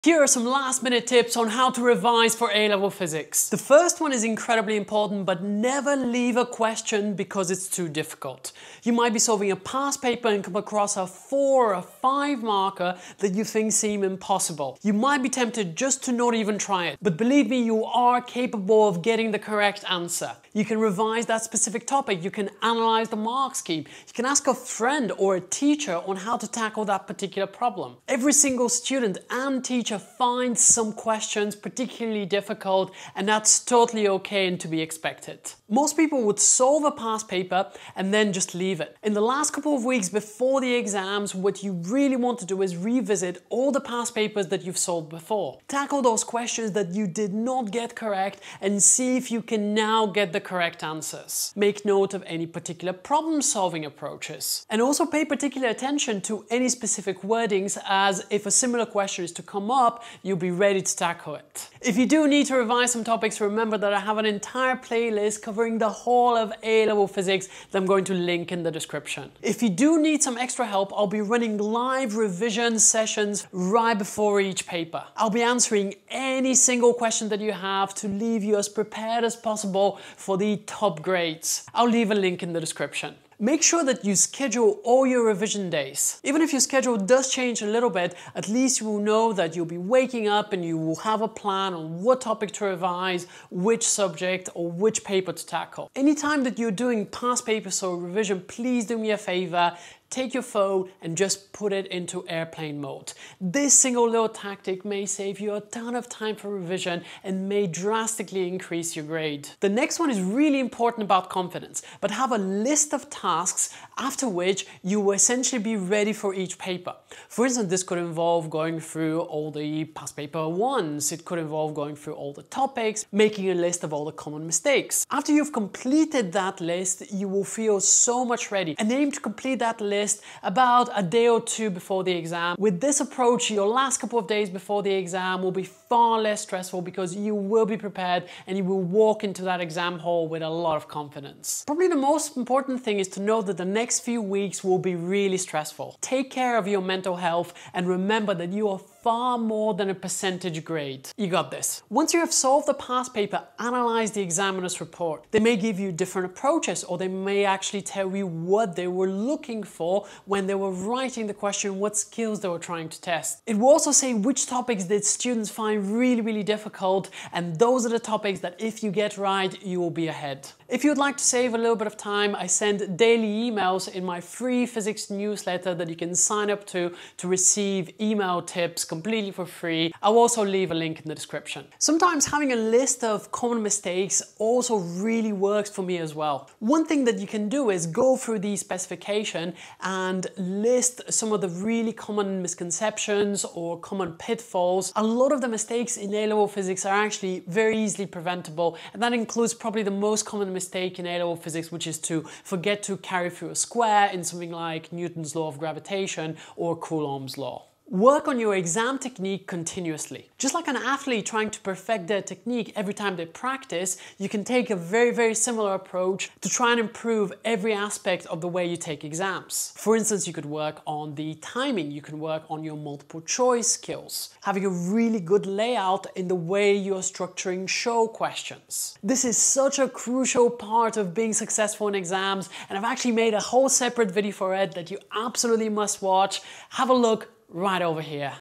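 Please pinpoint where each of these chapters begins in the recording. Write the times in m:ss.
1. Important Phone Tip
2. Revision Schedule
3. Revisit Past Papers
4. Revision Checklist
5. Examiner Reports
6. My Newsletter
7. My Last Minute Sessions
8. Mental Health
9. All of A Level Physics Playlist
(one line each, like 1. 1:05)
1. 1:35
2. 1:23
3. 0:35
4. 1:49
5. 2:31
6. 2:50
7. 1:10
8. 2:20
9. 0:59.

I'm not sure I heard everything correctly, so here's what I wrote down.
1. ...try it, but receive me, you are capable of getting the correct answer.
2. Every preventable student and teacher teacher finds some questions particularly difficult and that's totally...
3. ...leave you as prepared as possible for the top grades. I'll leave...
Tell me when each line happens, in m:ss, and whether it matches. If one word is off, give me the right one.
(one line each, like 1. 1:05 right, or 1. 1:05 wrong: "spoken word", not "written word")
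1. 0:16 wrong: "believe", not "receive"
2. 0:28 wrong: "single", not "preventable"
3. 1:18 right.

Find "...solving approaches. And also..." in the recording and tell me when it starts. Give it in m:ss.
0:53.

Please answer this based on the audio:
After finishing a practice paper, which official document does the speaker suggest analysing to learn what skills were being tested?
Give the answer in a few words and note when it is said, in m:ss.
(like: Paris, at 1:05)
Examiner's report, at 2:34.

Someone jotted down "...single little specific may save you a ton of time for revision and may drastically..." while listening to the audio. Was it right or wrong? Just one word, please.
wrong.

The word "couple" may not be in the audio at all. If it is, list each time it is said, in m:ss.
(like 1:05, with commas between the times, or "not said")
0:39, 2:14.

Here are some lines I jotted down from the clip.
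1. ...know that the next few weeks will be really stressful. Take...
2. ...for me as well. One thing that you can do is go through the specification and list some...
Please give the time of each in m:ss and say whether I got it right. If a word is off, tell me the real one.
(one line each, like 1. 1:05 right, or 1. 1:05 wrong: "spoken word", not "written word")
1. 2:23 right
2. 3:05 right.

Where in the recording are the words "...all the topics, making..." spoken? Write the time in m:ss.
2:02.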